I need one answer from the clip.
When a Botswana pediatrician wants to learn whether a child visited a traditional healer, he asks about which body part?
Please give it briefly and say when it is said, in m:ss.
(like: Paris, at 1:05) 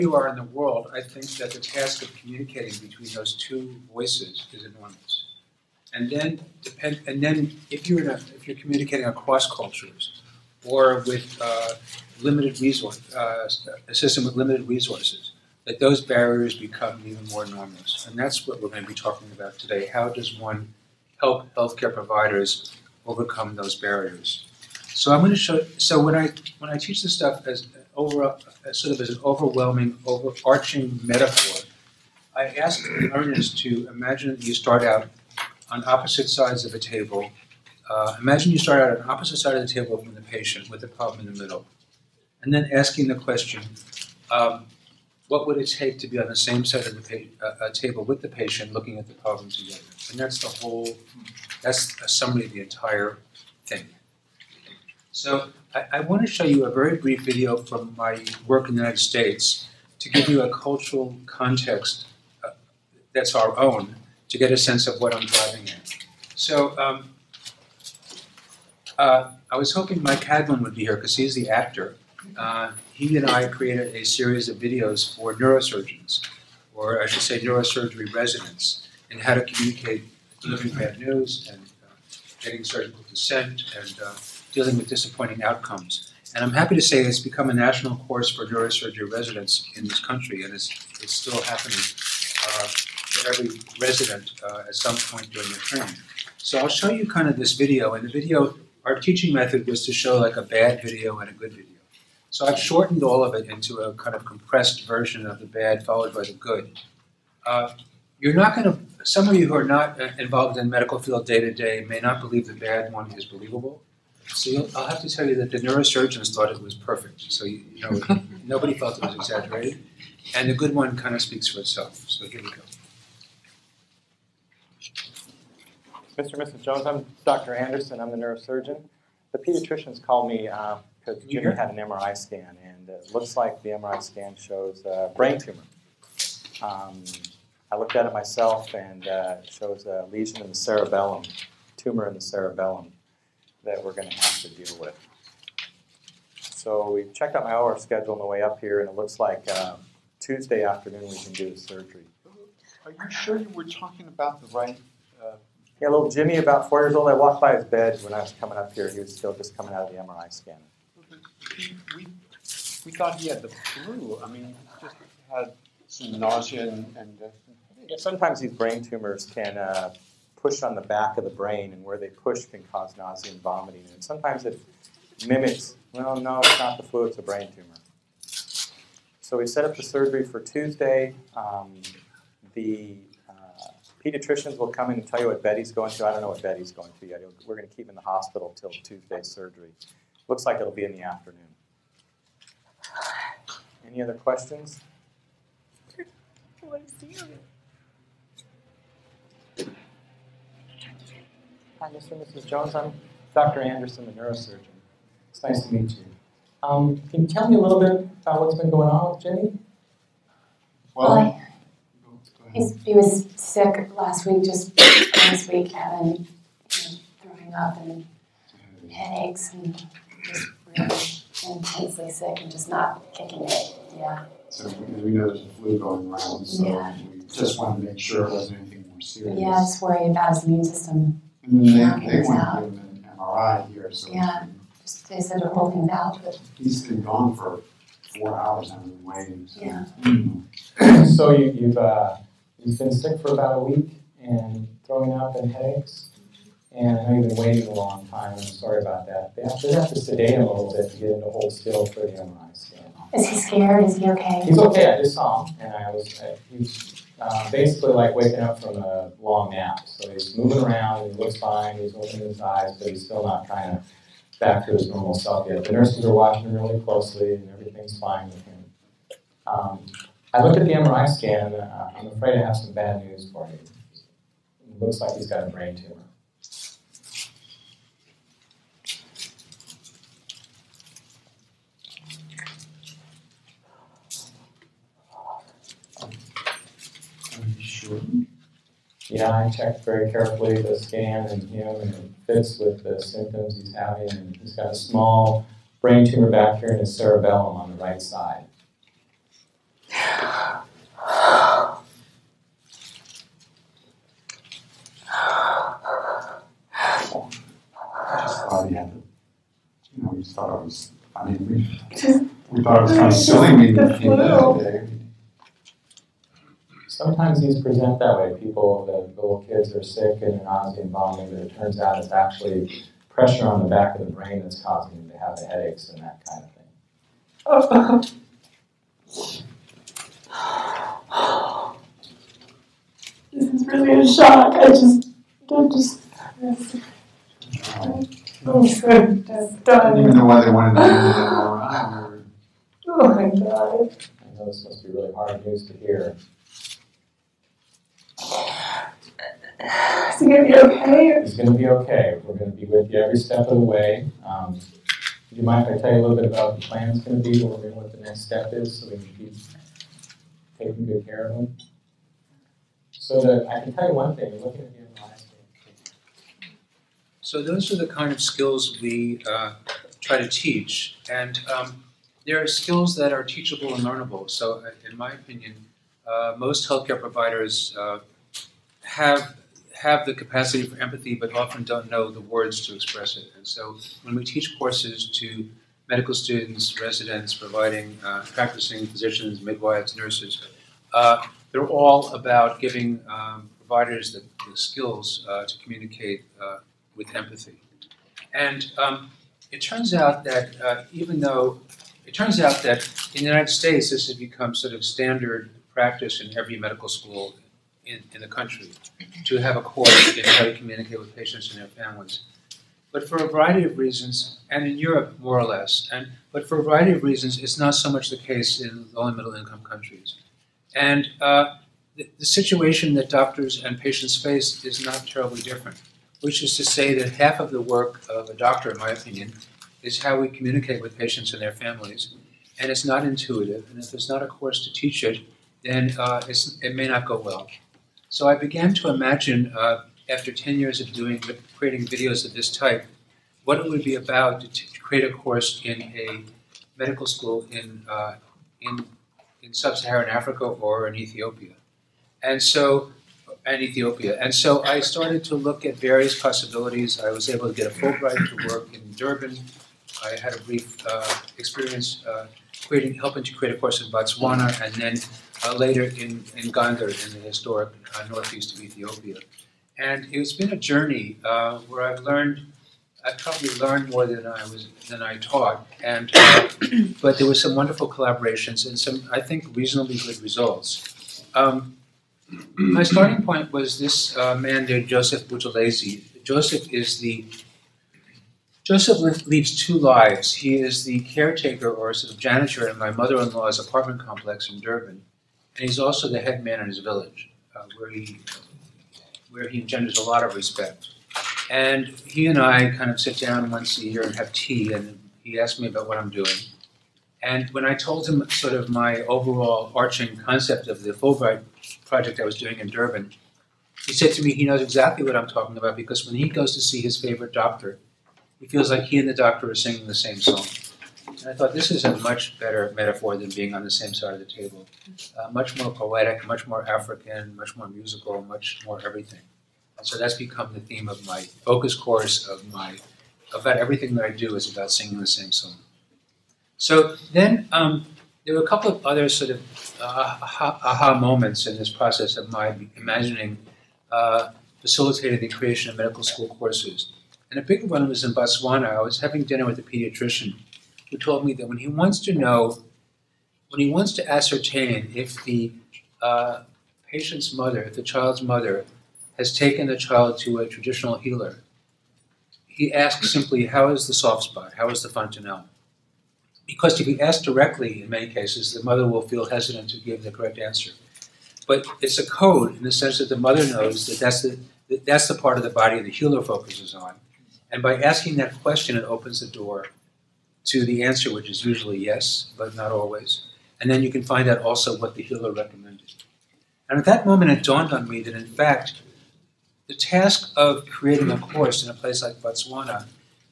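the fontanelle, at 9:24.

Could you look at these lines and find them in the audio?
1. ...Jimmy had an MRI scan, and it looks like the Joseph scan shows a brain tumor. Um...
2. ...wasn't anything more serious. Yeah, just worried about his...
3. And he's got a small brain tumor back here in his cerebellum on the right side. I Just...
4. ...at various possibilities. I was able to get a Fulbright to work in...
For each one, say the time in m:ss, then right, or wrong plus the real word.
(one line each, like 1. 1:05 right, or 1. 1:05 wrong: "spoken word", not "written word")
1. 2:11 wrong: "MRI", not "Joseph"
2. 3:48 right
3. 4:54 right
4. 7:35 right.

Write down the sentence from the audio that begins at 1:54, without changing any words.
So I'll have to tell you that the neurosurgeons thought it was perfect.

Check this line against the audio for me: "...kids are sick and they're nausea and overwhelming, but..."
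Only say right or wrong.
wrong.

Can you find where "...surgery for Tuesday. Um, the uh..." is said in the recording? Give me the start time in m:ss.
2:59.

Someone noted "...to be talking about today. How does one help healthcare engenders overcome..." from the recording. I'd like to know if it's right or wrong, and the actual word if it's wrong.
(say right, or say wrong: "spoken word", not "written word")
wrong: "providers", not "engenders".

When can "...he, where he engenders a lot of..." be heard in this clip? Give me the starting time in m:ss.
8:17.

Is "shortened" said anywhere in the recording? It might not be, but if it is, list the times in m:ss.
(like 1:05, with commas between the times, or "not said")
1:42.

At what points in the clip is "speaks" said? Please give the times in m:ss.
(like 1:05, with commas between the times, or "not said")
2:01.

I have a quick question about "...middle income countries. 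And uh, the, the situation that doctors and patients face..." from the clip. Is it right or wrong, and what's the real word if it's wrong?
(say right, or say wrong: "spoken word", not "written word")
right.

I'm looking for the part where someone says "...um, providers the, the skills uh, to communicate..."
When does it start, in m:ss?
6:33.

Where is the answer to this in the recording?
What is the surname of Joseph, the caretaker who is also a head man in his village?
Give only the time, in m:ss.
8:05.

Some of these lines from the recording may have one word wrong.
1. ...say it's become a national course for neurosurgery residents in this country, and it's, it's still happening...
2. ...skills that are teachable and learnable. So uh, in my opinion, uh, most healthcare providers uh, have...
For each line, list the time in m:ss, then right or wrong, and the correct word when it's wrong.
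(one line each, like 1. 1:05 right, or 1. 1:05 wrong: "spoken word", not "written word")
1. 1:26 right
2. 6:12 right.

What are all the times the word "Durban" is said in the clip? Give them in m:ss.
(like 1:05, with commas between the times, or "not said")
7:38, 8:14, 8:32.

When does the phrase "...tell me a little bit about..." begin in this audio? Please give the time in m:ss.
3:27.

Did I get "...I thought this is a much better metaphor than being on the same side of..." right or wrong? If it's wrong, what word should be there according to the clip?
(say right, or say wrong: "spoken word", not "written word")
right.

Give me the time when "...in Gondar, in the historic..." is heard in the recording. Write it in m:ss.
7:46.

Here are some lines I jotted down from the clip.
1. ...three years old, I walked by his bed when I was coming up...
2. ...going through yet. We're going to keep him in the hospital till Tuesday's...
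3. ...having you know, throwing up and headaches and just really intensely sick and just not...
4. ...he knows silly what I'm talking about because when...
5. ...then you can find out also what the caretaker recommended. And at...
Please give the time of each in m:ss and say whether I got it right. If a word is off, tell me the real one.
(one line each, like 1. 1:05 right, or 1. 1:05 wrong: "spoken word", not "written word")
1. 2:36 wrong: "four", not "three"
2. 3:06 right
3. 3:35 right
4. 8:34 wrong: "exactly", not "silly"
5. 9:43 wrong: "healer", not "caretaker".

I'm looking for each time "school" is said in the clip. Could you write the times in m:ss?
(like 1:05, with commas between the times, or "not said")
6:46, 7:27, 9:06.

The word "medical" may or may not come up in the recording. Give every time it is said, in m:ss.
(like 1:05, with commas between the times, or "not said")
1:50, 6:25, 6:46, 7:26, 9:05.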